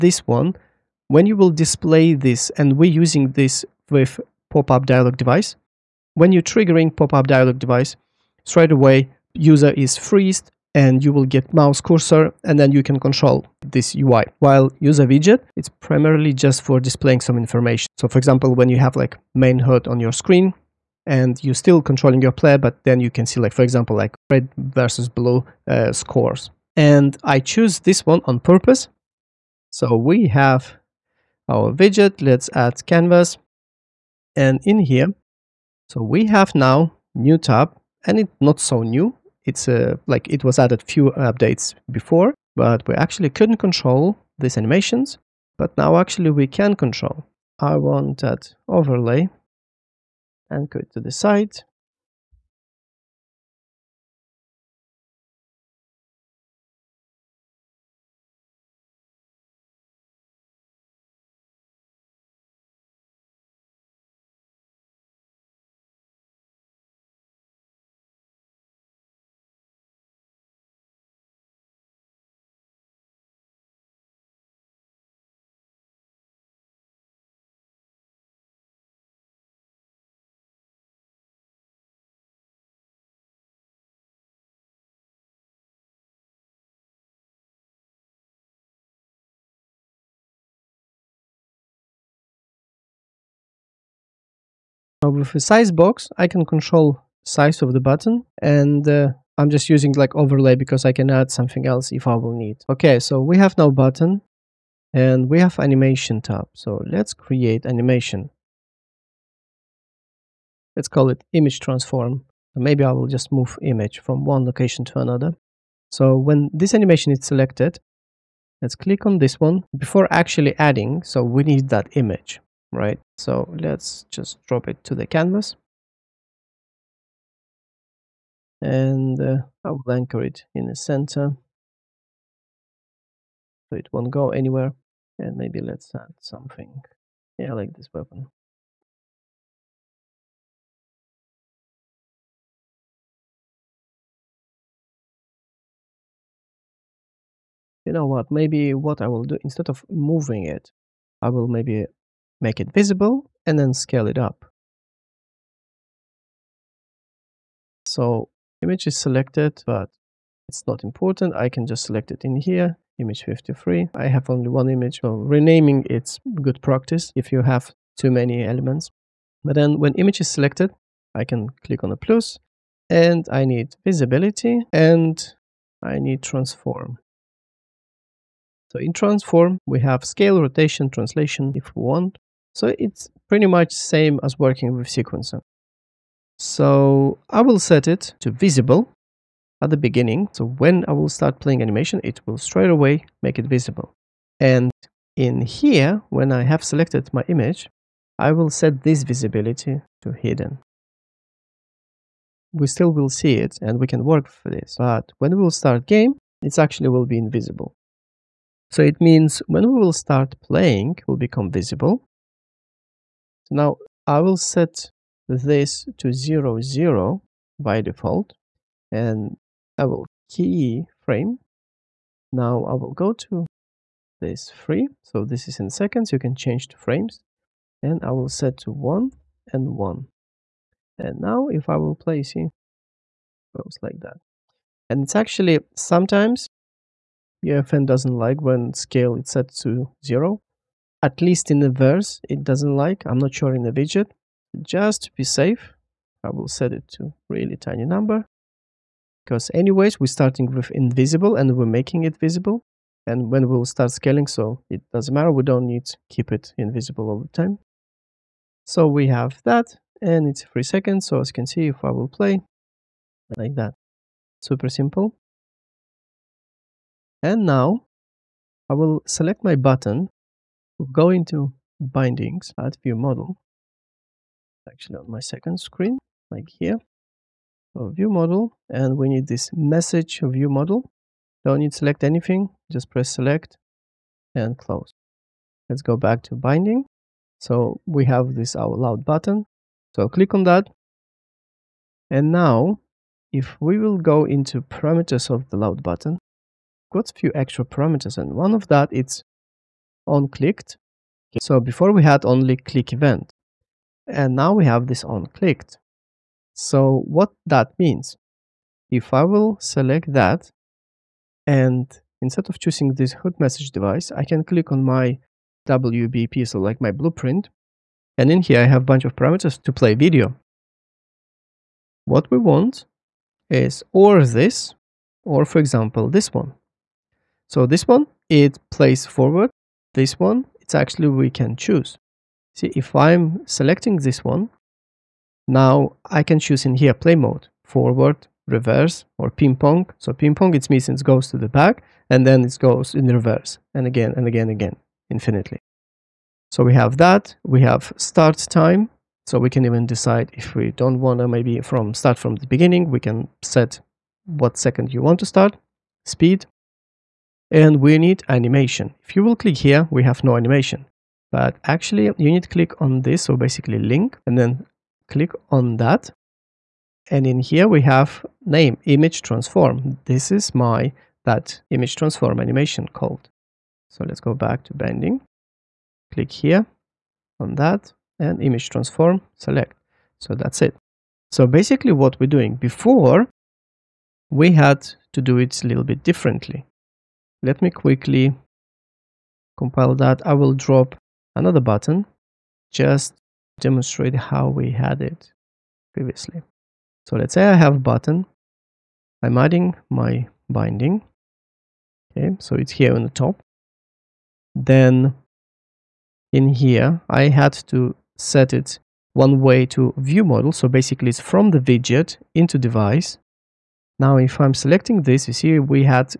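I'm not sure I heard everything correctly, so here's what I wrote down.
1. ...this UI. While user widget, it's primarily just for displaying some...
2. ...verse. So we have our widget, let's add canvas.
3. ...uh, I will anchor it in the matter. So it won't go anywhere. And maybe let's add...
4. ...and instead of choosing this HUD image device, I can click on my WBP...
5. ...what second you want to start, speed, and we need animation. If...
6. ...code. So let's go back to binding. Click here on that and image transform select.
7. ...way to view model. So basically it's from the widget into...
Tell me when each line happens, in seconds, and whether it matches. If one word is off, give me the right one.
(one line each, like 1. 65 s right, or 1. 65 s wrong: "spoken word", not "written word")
1. 13 s right
2. 28 s wrong: "purpose", not "verse"
3. 129 s wrong: "center", not "matter"
4. 311 s wrong: "message", not "image"
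5. 354 s right
6. 372 s right
7. 409 s right.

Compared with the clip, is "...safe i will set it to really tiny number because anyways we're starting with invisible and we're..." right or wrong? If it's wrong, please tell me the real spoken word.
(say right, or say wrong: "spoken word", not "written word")
right.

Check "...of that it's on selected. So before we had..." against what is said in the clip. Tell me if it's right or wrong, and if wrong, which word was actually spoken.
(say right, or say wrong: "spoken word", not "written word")
wrong: "clicked", not "selected".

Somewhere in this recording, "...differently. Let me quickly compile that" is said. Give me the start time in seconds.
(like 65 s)
386 s.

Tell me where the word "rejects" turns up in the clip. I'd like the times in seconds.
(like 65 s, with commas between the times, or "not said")
not said.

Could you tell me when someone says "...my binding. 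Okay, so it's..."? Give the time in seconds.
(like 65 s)
399 s.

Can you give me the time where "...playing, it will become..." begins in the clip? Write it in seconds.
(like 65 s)
210 s.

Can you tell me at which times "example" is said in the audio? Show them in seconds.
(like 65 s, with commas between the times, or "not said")
18 s, 23 s, 325 s.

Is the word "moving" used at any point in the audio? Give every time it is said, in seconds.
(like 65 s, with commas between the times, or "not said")
149 s.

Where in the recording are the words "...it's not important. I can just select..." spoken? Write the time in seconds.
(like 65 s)
160 s.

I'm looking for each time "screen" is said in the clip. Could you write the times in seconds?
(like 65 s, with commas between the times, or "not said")
20 s, 275 s.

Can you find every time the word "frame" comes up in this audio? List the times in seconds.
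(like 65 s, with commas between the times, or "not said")
221 s, 226 s.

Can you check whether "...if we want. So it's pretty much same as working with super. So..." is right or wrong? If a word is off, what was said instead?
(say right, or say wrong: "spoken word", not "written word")
wrong: "sequencer", not "super".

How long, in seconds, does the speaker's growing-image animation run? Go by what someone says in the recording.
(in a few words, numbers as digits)
3.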